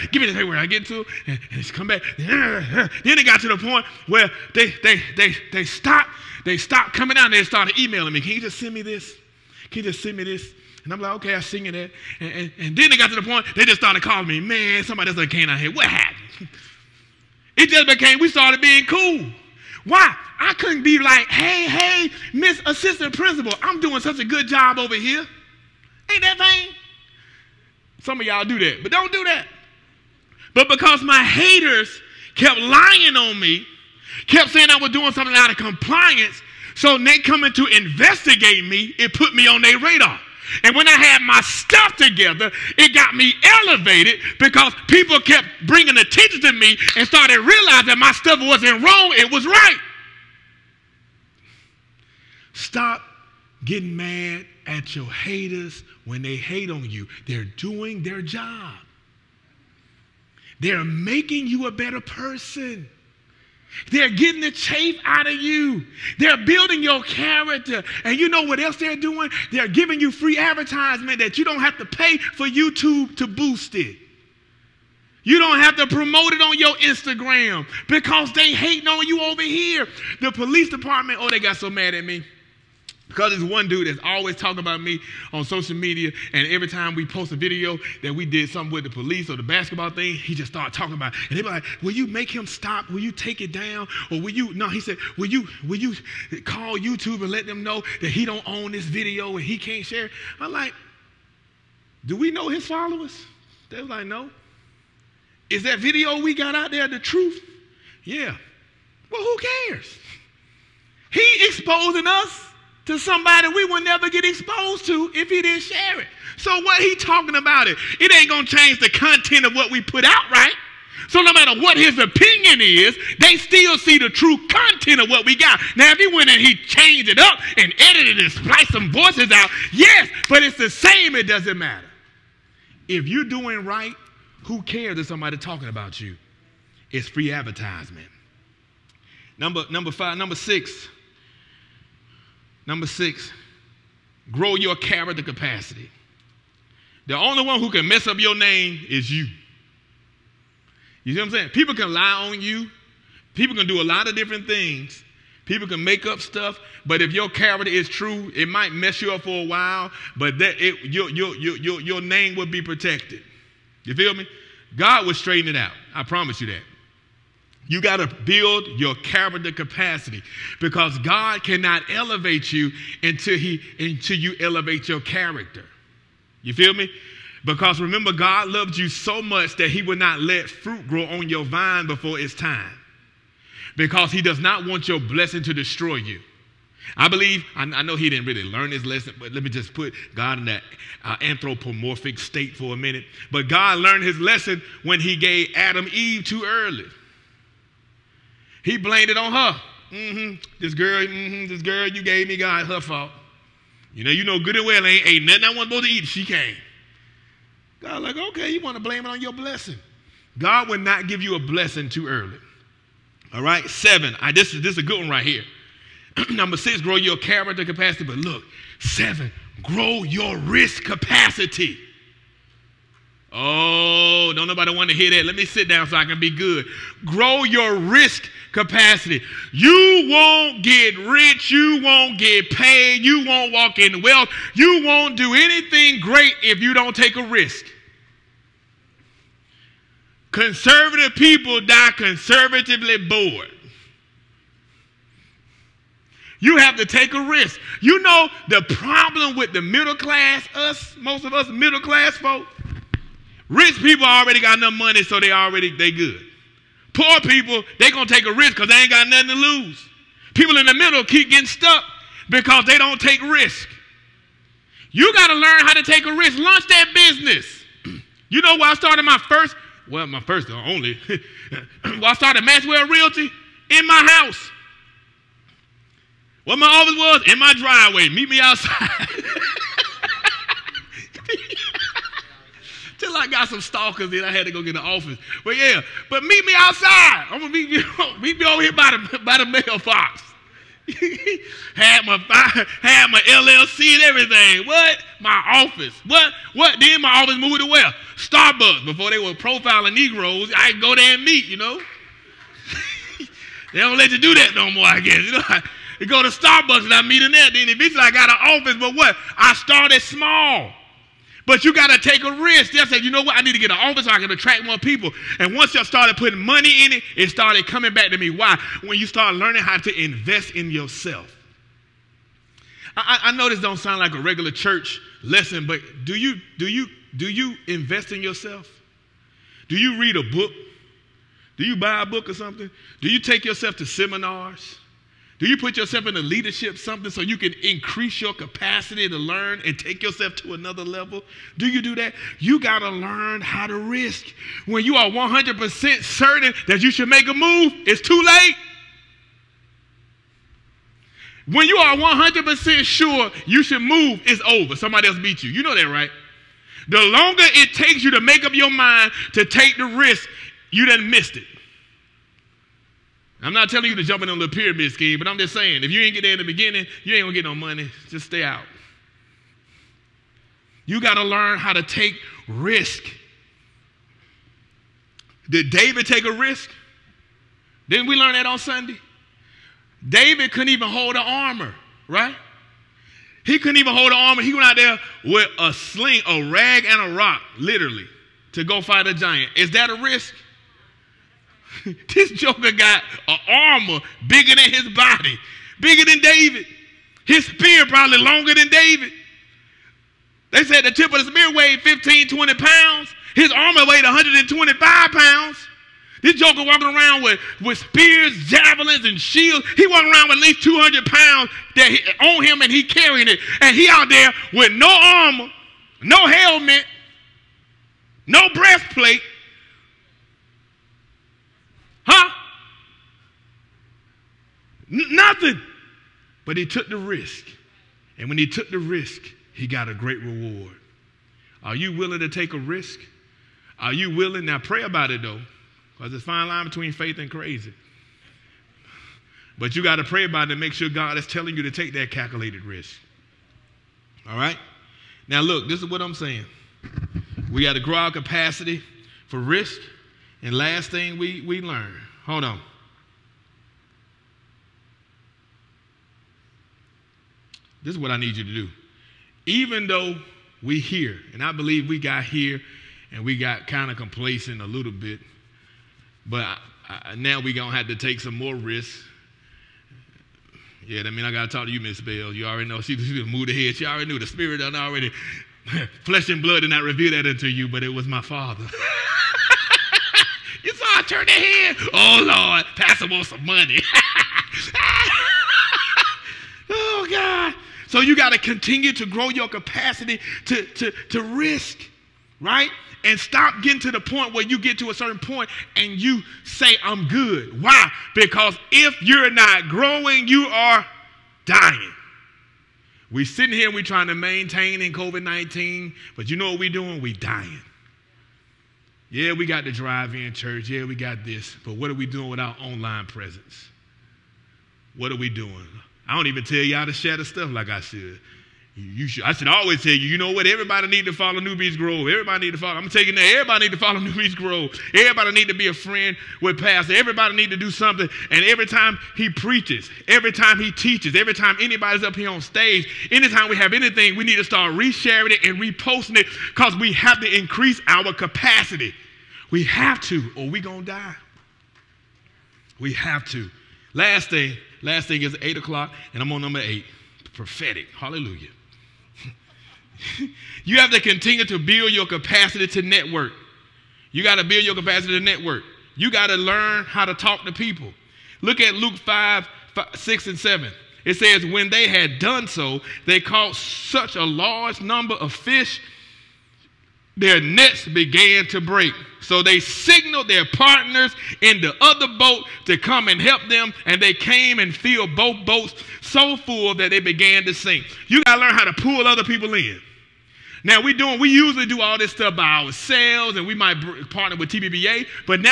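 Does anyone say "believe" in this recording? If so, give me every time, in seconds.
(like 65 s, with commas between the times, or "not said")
187 s, 461 s.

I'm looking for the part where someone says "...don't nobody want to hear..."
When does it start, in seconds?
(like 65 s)
224 s.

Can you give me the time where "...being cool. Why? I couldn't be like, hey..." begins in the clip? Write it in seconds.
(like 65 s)
18 s.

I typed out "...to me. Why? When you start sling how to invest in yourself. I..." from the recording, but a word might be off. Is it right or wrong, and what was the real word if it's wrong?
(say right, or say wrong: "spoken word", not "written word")
wrong: "learning", not "sling".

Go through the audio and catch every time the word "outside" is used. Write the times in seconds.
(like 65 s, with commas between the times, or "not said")
278 s, 286 s.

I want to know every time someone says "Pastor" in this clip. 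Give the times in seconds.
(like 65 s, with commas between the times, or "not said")
482 s, 526 s.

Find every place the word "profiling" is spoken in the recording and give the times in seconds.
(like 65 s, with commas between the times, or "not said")
299 s.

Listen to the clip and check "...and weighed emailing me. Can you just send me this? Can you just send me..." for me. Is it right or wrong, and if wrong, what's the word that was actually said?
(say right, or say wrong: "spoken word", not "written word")
wrong: "started", not "weighed".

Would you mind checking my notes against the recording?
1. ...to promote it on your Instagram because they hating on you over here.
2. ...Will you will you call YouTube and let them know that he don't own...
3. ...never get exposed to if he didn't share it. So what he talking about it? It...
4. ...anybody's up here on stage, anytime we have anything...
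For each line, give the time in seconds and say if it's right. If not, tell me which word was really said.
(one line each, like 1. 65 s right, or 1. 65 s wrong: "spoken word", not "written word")
1. 75 s right
2. 95 s right
3. 113 s right
4. 531 s right.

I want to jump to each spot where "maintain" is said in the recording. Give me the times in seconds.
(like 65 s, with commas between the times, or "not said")
504 s.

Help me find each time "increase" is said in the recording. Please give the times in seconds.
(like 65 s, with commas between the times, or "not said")
337 s, 537 s.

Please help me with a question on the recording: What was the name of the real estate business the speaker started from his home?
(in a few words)
Maxwell Realty.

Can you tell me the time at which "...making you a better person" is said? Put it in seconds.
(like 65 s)
60 s.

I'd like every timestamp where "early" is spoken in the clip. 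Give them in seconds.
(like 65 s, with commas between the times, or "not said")
196 s, 212 s.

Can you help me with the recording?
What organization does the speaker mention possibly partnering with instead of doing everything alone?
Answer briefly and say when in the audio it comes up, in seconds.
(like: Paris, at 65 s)
TBBA, at 584 s.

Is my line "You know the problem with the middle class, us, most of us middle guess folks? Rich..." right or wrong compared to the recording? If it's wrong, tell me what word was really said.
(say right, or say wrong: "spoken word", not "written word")
wrong: "class", not "guess".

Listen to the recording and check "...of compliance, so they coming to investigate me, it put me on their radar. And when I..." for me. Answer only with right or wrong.
right.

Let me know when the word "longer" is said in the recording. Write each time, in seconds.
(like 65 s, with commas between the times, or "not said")
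356 s, 398 s.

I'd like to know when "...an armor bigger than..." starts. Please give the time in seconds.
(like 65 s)
393 s.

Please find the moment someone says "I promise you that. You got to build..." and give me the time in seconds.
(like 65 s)
165 s.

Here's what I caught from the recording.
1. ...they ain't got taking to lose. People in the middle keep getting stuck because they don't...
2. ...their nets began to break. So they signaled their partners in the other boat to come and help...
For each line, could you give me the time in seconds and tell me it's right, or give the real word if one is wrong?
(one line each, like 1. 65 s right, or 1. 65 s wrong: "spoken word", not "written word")
1. 258 s wrong: "nothing", not "taking"
2. 567 s right.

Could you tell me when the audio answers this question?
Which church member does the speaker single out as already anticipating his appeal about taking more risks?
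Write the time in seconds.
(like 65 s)
471 s.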